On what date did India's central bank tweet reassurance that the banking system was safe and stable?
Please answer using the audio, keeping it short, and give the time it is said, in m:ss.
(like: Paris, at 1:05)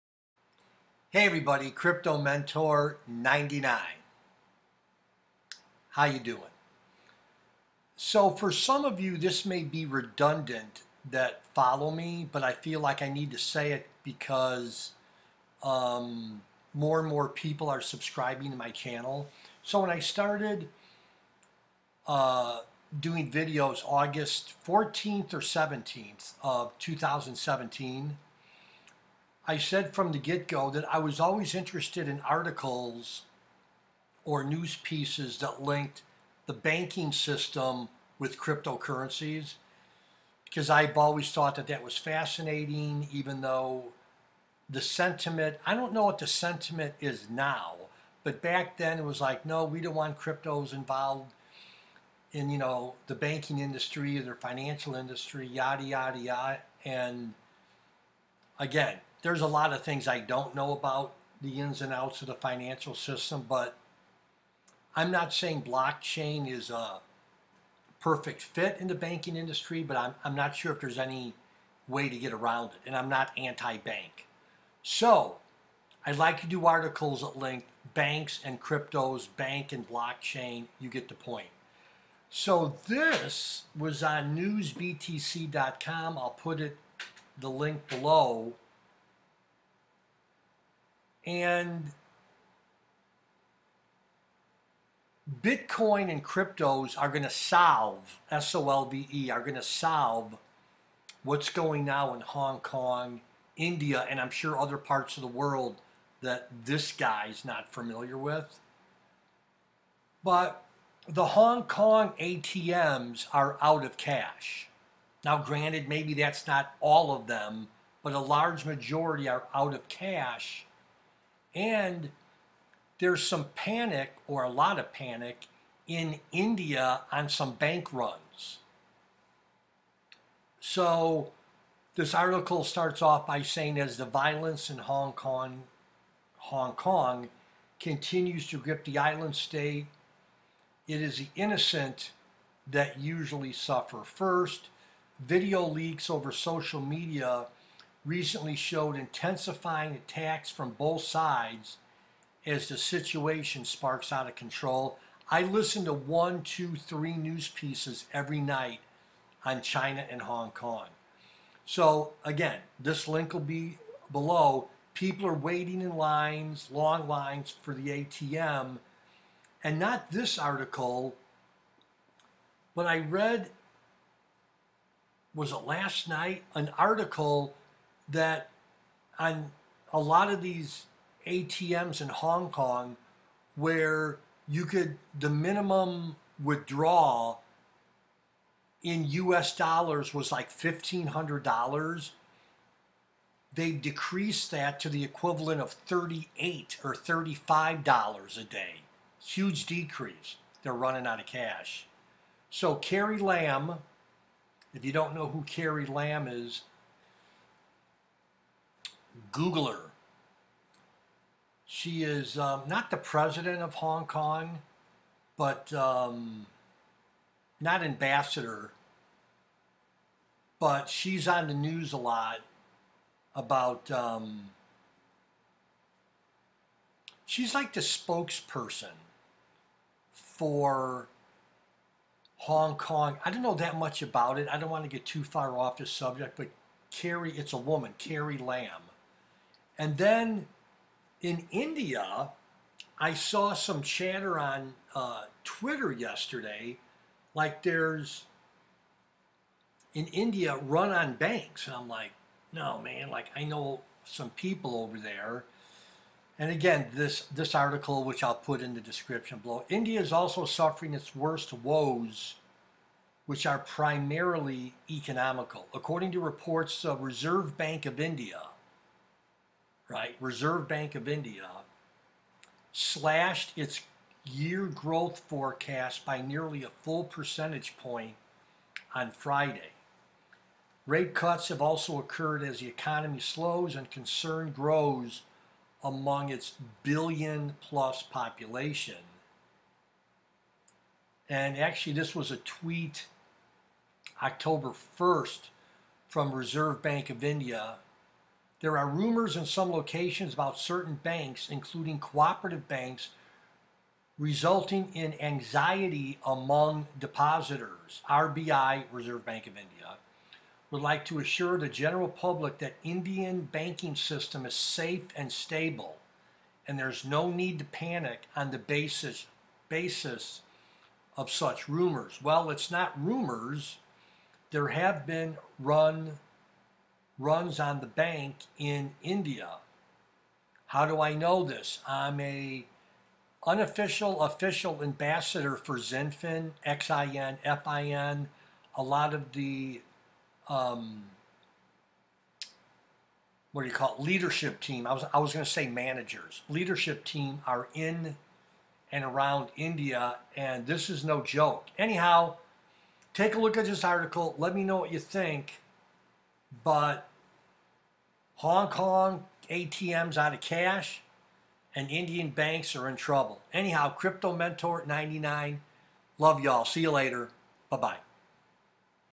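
October 1st, at 4:54.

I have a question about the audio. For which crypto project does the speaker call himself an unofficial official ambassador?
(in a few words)
XinFin.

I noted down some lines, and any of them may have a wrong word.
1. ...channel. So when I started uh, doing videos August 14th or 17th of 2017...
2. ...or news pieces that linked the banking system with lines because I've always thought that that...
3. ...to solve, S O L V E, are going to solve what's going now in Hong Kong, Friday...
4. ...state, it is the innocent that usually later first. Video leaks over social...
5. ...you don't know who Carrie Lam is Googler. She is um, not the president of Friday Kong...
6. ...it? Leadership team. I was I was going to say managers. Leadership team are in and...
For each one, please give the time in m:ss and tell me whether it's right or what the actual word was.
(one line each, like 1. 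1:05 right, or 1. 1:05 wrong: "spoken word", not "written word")
1. 0:18 right
2. 0:34 wrong: "cryptocurrencies", not "lines"
3. 1:37 wrong: "India", not "Friday"
4. 2:19 wrong: "suffer", not "later"
5. 3:24 wrong: "Hong", not "Friday"
6. 5:43 right.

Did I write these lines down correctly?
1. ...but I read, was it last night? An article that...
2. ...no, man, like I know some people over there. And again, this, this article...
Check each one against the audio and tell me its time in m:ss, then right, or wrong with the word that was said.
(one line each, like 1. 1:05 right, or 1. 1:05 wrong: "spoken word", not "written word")
1. 2:52 right
2. 4:12 right.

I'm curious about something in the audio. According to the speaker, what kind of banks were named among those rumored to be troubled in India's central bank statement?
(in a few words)
cooperative banks.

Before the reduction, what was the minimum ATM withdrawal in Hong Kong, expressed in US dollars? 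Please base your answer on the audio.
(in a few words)
$1500.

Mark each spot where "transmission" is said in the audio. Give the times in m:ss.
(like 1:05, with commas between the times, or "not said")
not said.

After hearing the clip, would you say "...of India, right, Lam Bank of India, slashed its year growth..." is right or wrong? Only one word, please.
wrong.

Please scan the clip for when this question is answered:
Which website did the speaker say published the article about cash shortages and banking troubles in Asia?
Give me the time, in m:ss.
1:24.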